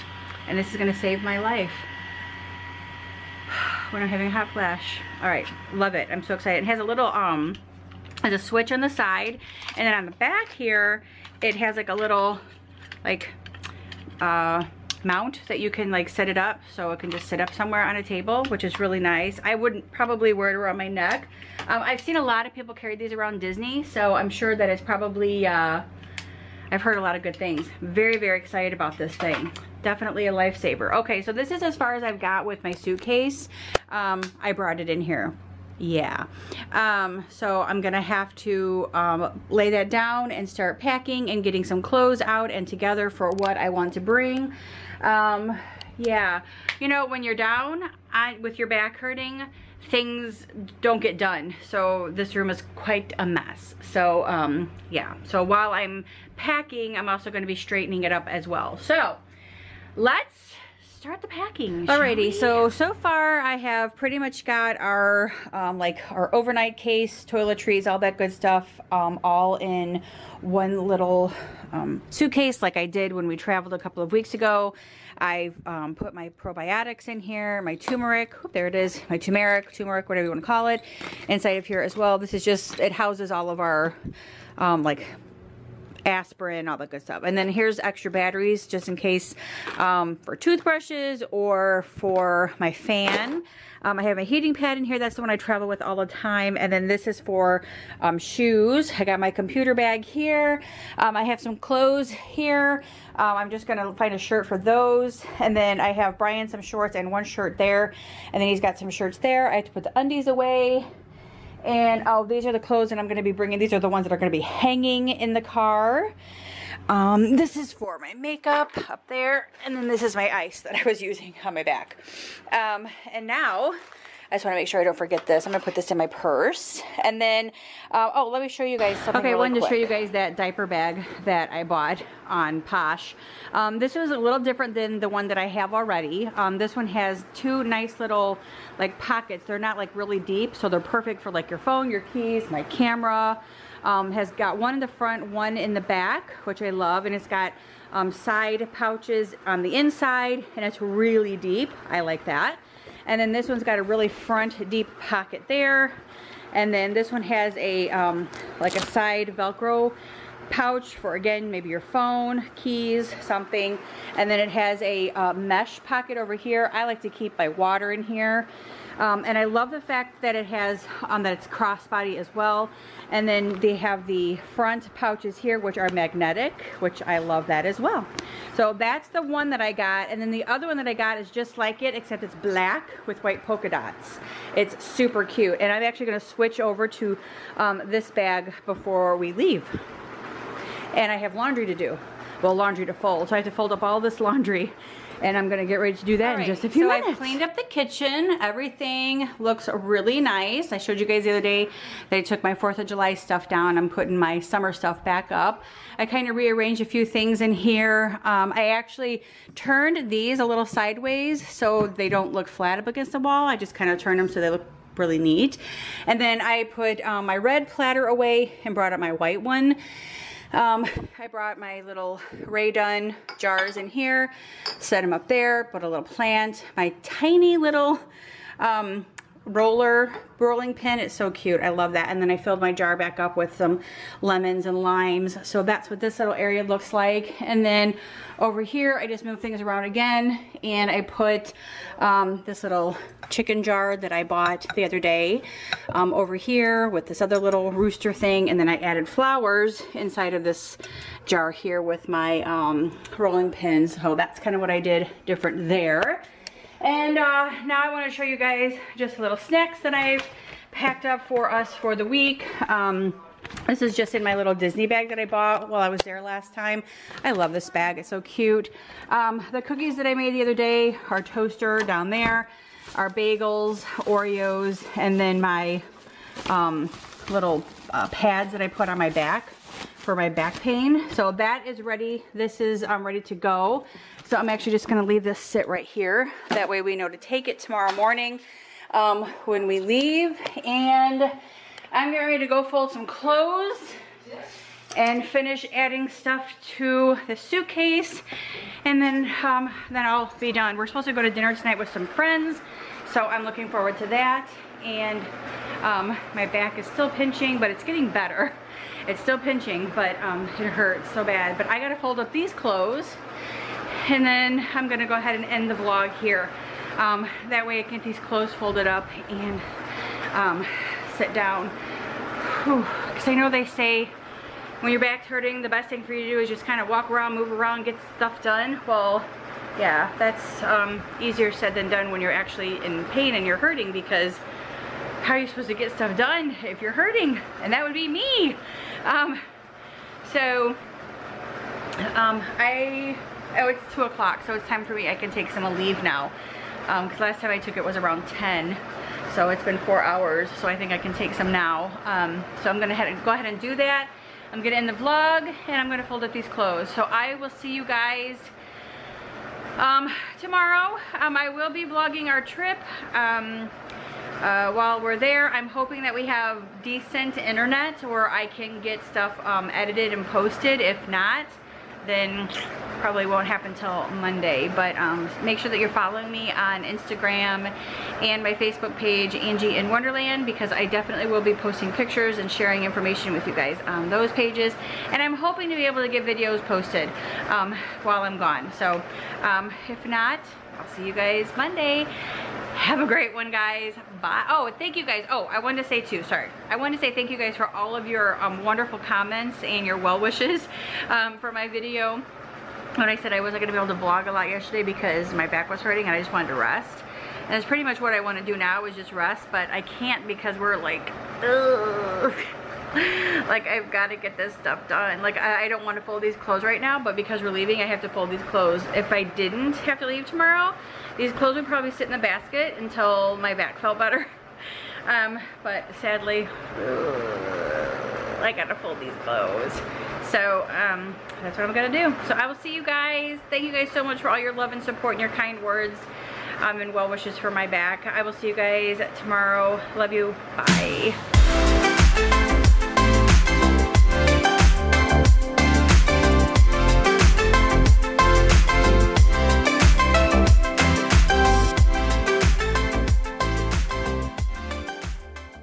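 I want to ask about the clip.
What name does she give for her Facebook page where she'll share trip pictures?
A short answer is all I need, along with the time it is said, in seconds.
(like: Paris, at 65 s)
Angie in Wonderland, at 379 s.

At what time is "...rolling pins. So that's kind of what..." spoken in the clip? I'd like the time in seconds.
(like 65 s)
253 s.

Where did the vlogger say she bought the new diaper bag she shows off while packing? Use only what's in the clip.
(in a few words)
Posh.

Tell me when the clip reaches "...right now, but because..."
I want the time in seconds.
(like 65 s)
416 s.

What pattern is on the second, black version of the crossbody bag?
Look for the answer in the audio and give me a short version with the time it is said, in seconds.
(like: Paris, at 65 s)
white polka dots, at 183 s.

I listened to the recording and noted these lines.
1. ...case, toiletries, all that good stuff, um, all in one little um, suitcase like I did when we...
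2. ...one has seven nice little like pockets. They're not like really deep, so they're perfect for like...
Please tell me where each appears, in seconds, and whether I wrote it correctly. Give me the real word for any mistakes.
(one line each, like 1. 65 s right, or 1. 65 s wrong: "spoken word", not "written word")
1. 66 s right
2. 136 s wrong: "two", not "seven".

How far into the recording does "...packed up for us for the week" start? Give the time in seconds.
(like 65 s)
260 s.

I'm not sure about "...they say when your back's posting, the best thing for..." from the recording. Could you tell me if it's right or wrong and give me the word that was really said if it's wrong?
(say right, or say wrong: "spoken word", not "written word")
wrong: "hurting", not "posting".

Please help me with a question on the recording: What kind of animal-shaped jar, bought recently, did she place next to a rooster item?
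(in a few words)
chicken.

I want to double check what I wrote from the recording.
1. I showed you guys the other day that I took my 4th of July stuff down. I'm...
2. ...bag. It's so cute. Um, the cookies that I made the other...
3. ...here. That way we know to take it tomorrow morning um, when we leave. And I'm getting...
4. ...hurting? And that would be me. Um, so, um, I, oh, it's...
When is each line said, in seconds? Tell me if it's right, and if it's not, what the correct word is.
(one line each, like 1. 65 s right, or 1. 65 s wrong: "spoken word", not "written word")
1. 200 s right
2. 267 s right
3. 285 s right
4. 336 s right.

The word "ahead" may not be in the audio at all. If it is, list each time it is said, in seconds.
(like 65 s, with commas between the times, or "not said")
315 s, 353 s.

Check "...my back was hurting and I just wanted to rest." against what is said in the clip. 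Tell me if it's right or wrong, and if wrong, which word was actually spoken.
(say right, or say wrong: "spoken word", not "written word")
right.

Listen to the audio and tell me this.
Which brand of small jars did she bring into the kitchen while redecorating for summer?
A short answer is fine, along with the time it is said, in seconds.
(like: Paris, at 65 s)
Rae Dunn, at 222 s.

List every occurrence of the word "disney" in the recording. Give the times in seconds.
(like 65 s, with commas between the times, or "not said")
23 s, 264 s.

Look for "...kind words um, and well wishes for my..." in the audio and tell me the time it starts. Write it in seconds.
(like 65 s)
435 s.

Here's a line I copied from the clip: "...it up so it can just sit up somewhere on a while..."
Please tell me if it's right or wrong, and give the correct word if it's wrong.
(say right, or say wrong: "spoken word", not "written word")
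wrong: "table", not "while".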